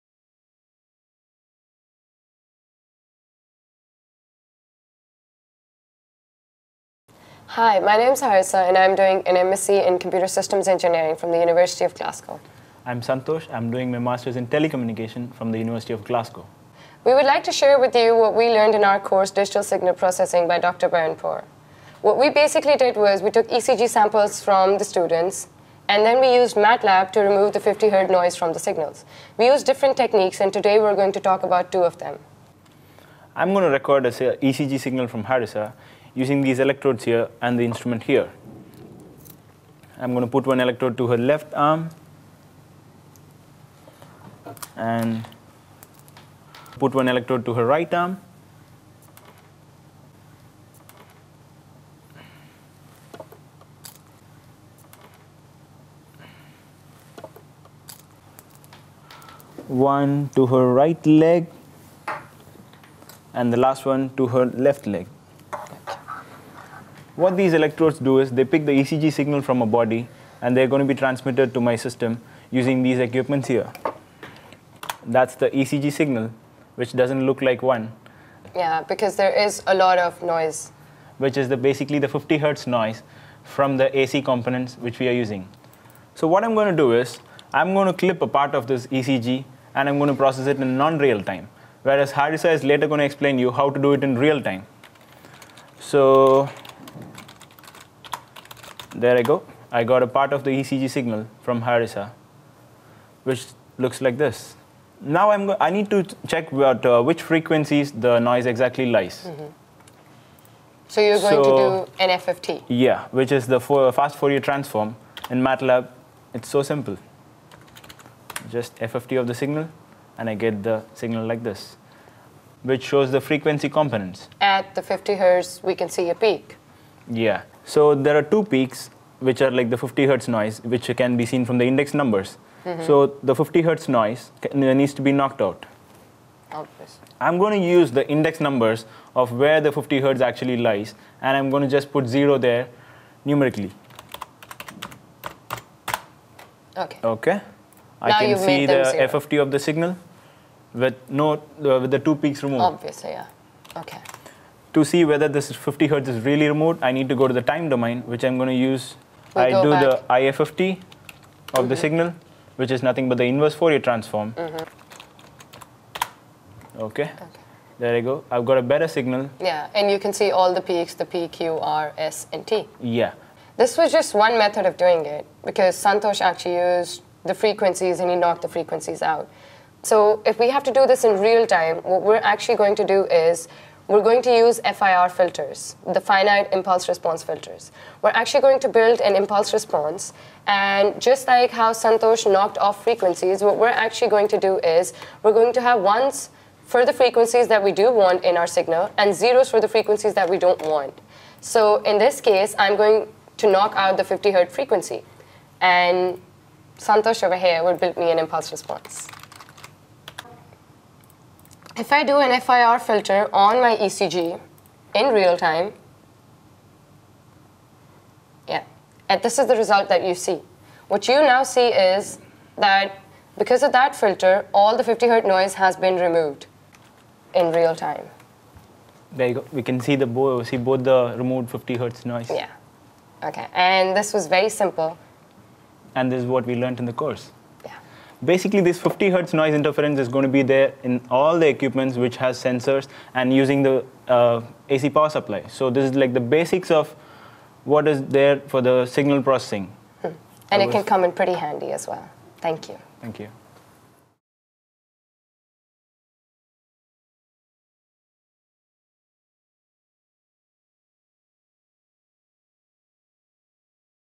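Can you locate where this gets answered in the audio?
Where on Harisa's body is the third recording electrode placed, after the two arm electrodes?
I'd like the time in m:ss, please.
1:00.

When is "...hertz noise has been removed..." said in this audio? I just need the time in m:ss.
3:45.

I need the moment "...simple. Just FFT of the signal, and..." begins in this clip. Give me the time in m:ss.
1:56.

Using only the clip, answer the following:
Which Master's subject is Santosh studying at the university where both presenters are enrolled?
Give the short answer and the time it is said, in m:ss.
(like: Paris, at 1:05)
Telecommunication, at 0:14.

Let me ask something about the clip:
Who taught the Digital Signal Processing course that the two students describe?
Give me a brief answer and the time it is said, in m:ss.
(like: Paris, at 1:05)
Dr. Bernd Porr, at 0:20.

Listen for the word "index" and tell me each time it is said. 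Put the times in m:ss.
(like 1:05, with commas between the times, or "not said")
2:11, 2:18.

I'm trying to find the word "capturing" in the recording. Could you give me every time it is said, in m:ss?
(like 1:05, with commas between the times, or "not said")
not said.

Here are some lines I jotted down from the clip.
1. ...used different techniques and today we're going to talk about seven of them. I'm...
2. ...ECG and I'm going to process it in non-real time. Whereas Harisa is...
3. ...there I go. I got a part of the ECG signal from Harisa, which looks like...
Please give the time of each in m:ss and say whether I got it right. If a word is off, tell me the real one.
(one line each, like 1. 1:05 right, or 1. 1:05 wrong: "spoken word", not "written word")
1. 0:29 wrong: "two", not "seven"
2. 1:28 right
3. 1:38 right.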